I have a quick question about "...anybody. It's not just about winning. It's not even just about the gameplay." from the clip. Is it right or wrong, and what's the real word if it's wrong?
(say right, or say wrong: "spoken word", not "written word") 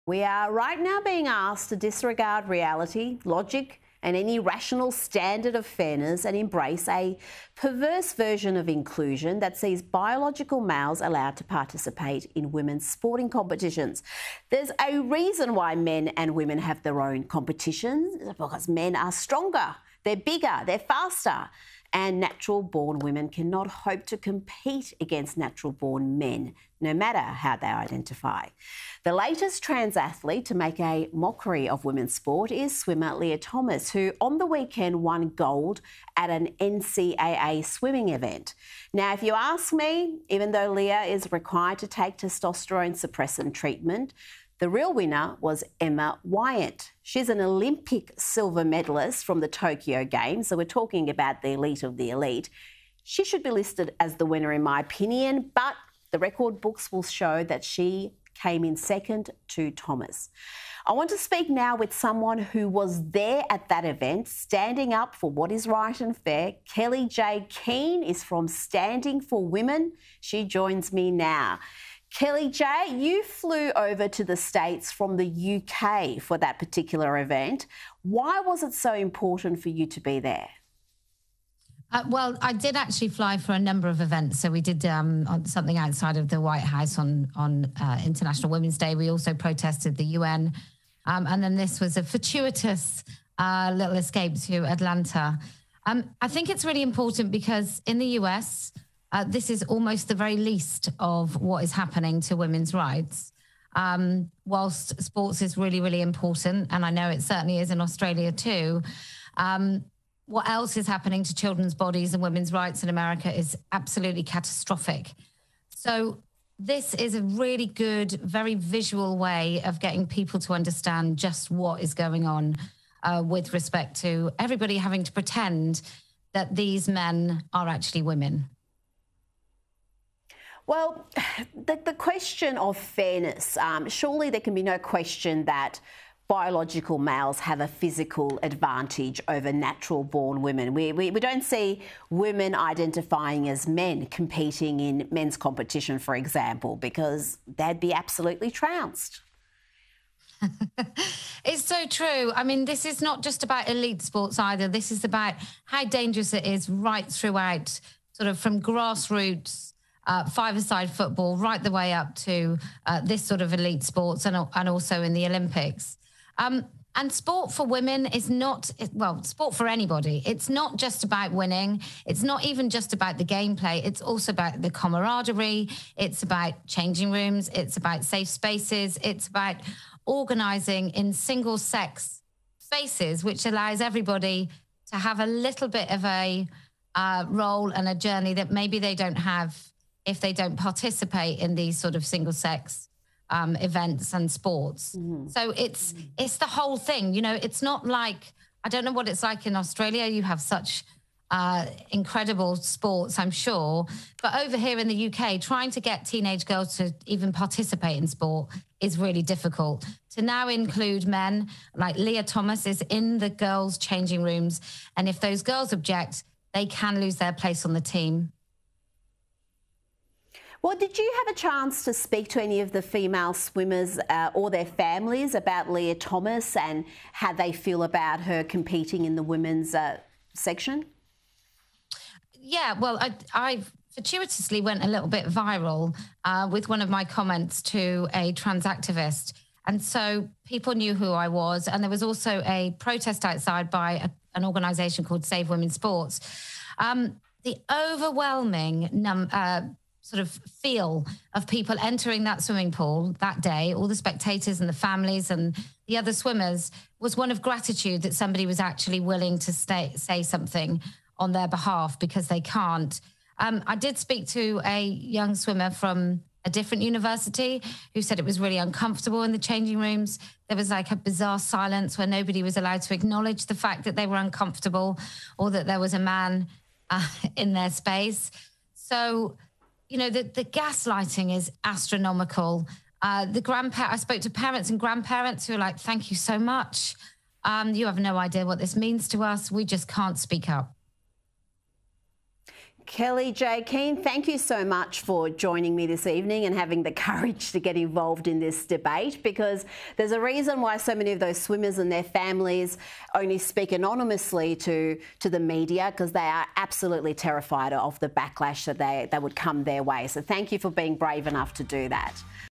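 right.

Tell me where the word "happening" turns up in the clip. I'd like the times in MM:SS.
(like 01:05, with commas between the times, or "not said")
01:41, 01:50.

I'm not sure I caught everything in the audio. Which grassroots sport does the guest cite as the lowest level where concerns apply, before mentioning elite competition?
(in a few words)
five-a-side football.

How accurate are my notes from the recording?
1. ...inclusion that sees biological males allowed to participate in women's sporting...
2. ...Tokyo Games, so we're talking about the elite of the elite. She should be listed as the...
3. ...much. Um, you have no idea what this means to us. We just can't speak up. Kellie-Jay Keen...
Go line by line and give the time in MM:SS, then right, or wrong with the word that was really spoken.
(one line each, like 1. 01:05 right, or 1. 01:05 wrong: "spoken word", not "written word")
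1. 00:08 right
2. 00:49 right
3. 04:46 right.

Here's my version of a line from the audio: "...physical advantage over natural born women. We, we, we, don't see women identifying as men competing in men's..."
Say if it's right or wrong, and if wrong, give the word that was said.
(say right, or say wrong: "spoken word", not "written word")
right.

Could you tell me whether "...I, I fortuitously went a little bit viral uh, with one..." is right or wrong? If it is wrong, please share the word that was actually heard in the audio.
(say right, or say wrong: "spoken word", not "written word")
right.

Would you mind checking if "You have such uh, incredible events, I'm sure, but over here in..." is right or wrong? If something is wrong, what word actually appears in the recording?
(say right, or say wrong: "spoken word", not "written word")
wrong: "sports", not "events".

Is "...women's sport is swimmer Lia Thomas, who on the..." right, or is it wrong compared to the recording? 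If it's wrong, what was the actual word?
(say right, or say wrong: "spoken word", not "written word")
right.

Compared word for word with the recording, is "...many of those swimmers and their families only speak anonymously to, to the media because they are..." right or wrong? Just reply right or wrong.
right.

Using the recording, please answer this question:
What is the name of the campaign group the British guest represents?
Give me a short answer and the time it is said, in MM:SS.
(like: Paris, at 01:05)
Standing for Women, at 01:08.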